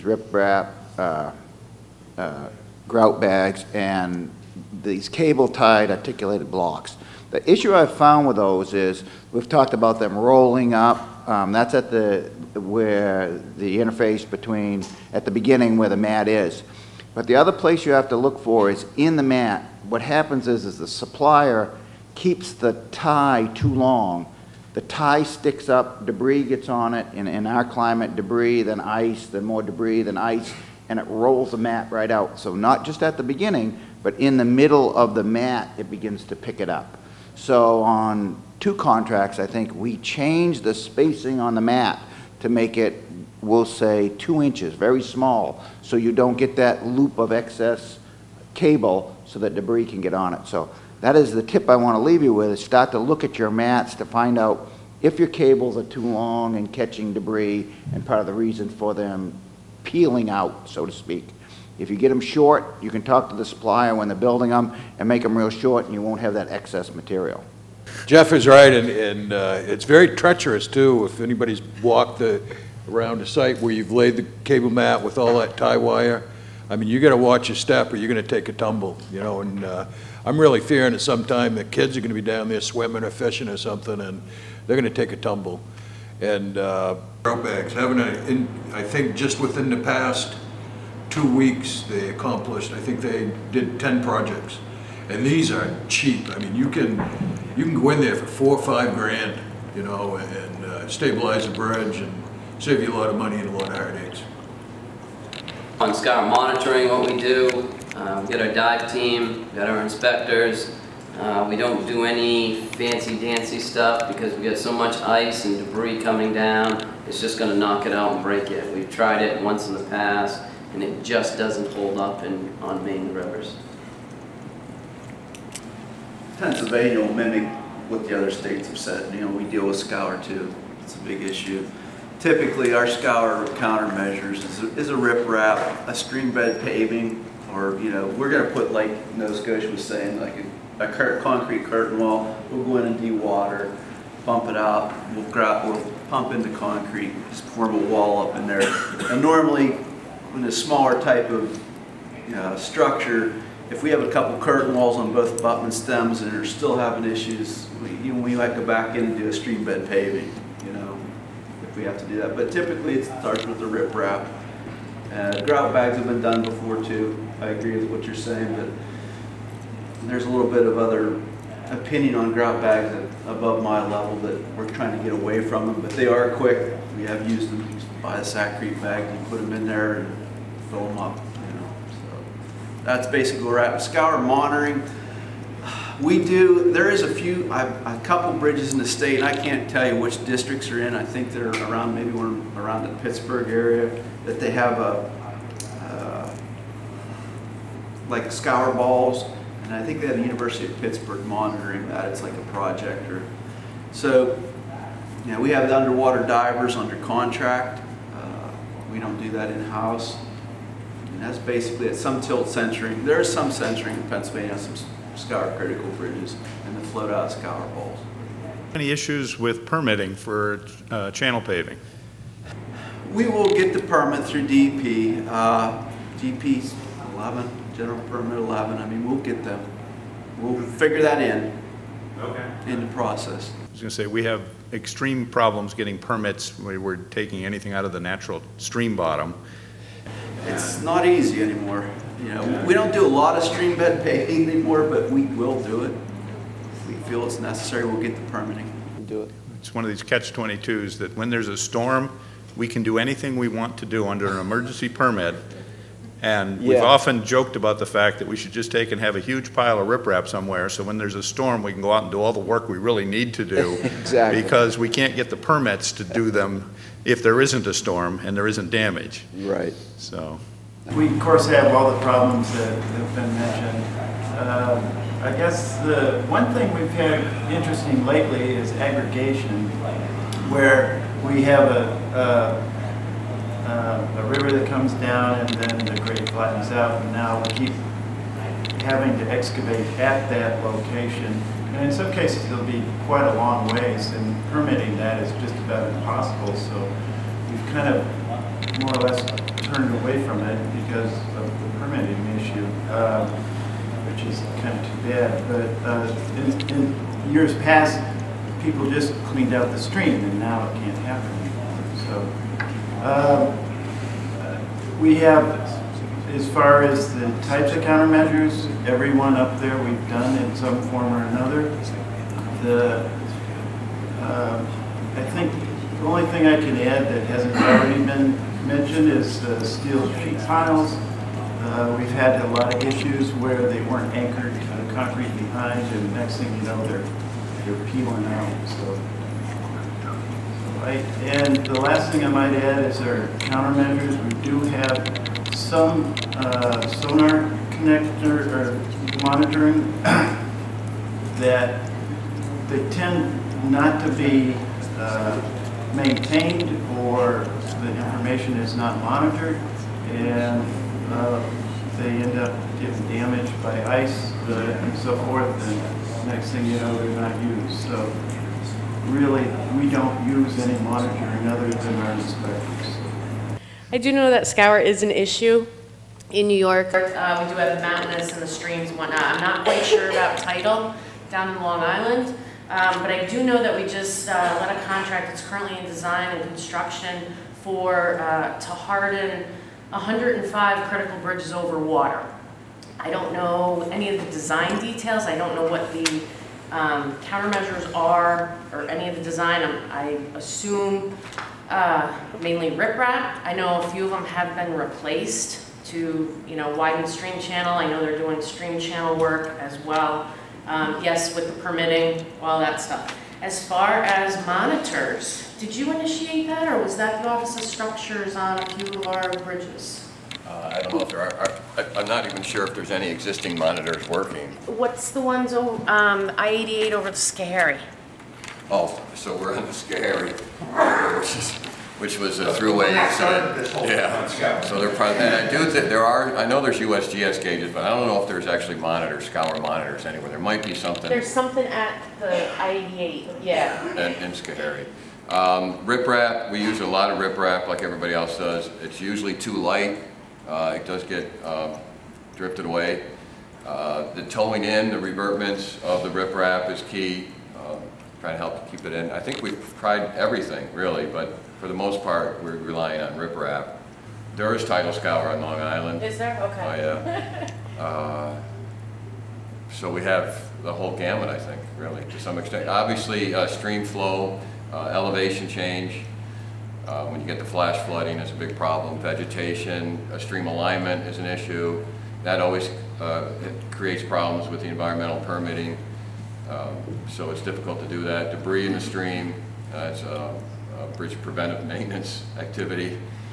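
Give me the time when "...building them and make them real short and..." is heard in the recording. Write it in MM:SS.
01:04.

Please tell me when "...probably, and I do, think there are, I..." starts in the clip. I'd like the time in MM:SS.
07:14.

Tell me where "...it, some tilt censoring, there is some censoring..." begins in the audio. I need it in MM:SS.
03:31.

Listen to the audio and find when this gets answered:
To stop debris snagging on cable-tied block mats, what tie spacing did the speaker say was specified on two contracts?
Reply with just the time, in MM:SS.
00:44.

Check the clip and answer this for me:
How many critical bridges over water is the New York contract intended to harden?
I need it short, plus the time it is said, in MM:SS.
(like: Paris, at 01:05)
105, at 06:29.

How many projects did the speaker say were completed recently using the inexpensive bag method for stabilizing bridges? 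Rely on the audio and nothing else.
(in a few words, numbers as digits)
10.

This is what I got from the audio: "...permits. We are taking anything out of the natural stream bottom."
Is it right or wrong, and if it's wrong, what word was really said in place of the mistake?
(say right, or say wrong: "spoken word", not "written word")
right.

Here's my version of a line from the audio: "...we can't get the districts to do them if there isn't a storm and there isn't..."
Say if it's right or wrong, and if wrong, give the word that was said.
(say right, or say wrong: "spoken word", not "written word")
wrong: "permits", not "districts".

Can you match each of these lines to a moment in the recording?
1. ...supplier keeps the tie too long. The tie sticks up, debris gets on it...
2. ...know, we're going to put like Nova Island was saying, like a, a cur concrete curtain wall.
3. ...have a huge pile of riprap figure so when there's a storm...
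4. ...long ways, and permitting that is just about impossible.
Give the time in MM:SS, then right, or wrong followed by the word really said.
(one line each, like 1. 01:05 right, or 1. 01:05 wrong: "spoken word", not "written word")
1. 00:20 right
2. 02:17 wrong: "Scotia", not "Island"
3. 04:18 wrong: "somewhere", not "figure"
4. 04:53 right.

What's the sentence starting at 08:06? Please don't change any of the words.
Um, so it's difficult to do that.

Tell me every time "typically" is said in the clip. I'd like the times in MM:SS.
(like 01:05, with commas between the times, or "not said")
02:12, 02:42.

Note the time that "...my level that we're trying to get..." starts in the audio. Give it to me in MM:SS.
02:53.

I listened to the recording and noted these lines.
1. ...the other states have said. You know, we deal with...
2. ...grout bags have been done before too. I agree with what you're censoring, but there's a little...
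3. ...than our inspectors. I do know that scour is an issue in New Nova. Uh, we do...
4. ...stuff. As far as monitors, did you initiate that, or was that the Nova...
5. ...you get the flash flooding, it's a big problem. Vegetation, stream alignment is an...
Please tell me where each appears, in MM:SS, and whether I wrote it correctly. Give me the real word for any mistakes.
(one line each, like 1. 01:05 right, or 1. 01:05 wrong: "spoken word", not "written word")
1. 02:08 right
2. 02:45 wrong: "saying", not "censoring"
3. 06:11 wrong: "York", not "Nova"
4. 06:52 wrong: "Office", not "Nova"
5. 07:57 right.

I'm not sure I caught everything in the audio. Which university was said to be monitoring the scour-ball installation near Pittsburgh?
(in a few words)
University of Pittsburgh.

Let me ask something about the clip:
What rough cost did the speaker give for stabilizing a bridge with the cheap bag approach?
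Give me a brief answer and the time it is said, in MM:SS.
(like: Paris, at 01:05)
four or five grand, at 01:38.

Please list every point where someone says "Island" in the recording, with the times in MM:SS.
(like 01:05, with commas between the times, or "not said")
06:21, 07:45.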